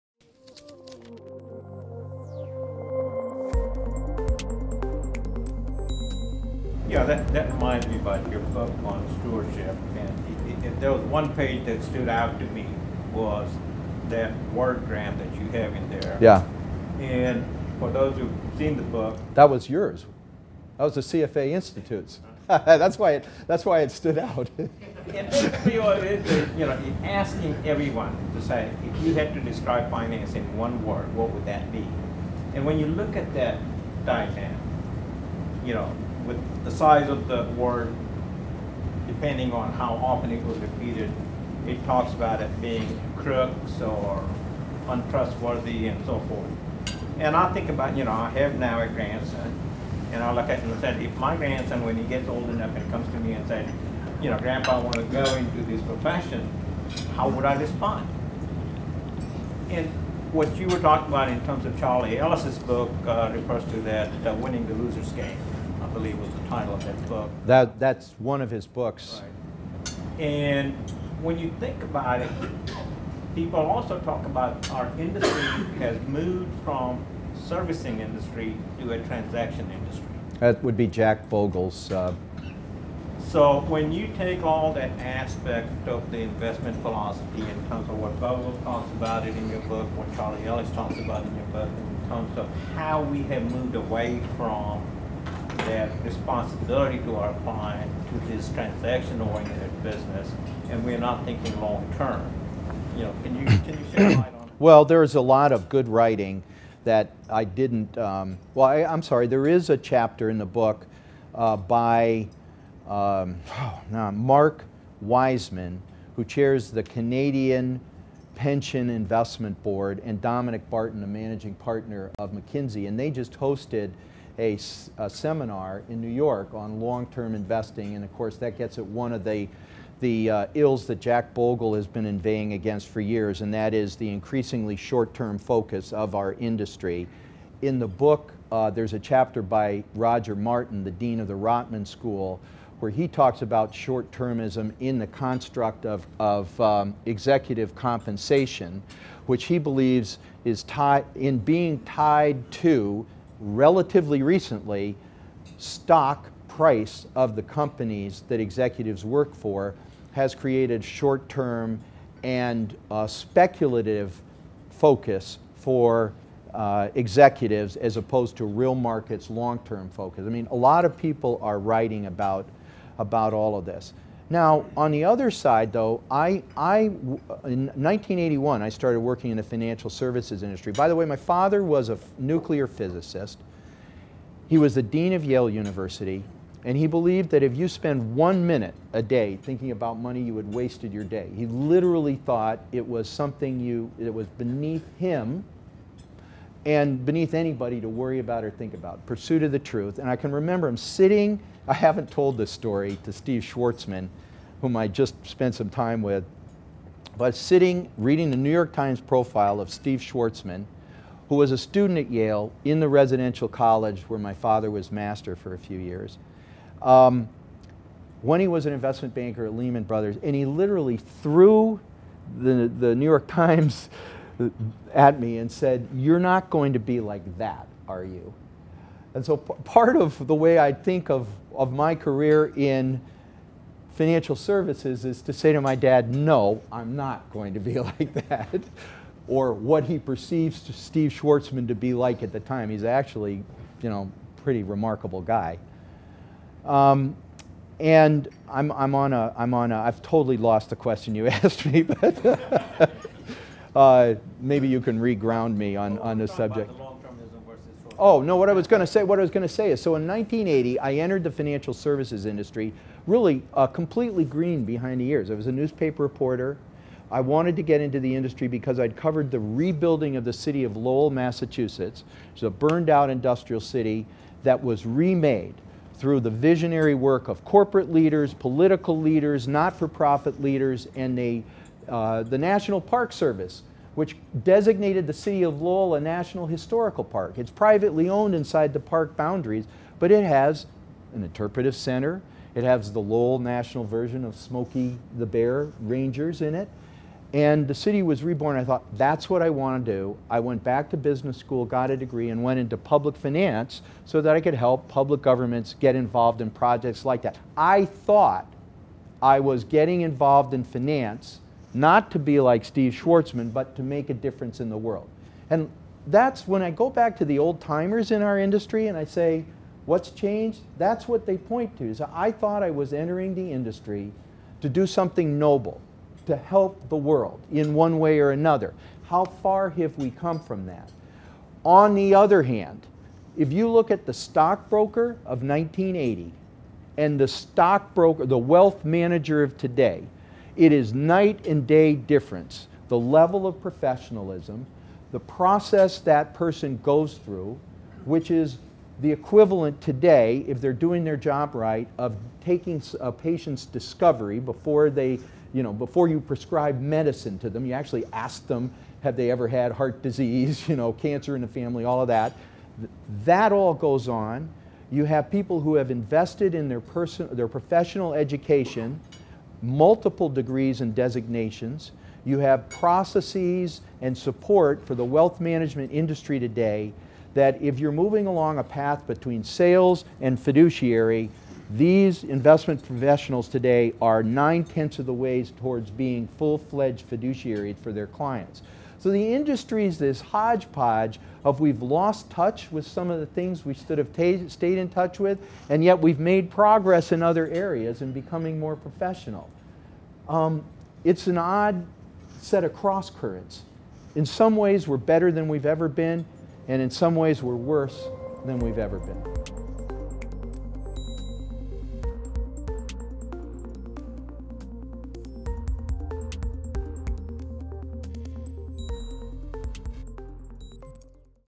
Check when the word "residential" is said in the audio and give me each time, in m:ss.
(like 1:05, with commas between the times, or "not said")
3:32.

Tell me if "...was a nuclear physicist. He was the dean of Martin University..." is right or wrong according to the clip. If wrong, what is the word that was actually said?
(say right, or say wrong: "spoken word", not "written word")
wrong: "Yale", not "Martin".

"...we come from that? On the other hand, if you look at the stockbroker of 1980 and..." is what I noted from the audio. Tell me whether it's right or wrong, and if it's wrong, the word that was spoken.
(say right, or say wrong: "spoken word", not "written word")
right.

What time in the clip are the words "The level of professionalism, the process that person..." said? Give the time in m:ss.
5:42.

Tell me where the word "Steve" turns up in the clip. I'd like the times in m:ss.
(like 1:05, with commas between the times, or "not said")
3:23, 3:29, 4:00, 5:12.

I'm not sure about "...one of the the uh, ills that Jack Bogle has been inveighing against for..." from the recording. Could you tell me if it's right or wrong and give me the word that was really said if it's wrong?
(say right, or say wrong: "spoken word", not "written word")
right.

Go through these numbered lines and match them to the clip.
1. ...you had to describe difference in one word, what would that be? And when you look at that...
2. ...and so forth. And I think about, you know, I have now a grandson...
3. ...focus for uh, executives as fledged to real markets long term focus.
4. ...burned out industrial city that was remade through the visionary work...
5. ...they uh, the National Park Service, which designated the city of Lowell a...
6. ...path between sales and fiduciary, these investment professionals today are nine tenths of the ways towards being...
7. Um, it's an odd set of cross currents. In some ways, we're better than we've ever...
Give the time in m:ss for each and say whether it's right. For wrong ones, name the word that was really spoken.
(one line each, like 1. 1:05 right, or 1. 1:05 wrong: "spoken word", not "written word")
1. 0:29 wrong: "finance", not "difference"
2. 0:45 right
3. 2:44 wrong: "opposed", not "fledged"
4. 4:32 right
5. 4:41 right
6. 6:18 right
7. 6:40 right.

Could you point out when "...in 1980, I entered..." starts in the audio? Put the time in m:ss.
4:19.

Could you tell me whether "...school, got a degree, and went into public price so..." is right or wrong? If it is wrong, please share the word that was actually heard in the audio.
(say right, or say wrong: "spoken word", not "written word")
wrong: "finance", not "price".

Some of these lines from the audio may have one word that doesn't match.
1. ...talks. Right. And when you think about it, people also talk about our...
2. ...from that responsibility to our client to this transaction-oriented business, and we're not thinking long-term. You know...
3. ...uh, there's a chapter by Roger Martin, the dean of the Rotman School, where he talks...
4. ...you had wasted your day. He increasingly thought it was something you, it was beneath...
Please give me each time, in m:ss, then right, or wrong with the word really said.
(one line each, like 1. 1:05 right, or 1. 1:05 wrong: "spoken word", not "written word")
1. 1:08 wrong: "books", not "talks"
2. 1:34 right
3. 2:18 right
4. 3:10 wrong: "literally", not "increasingly".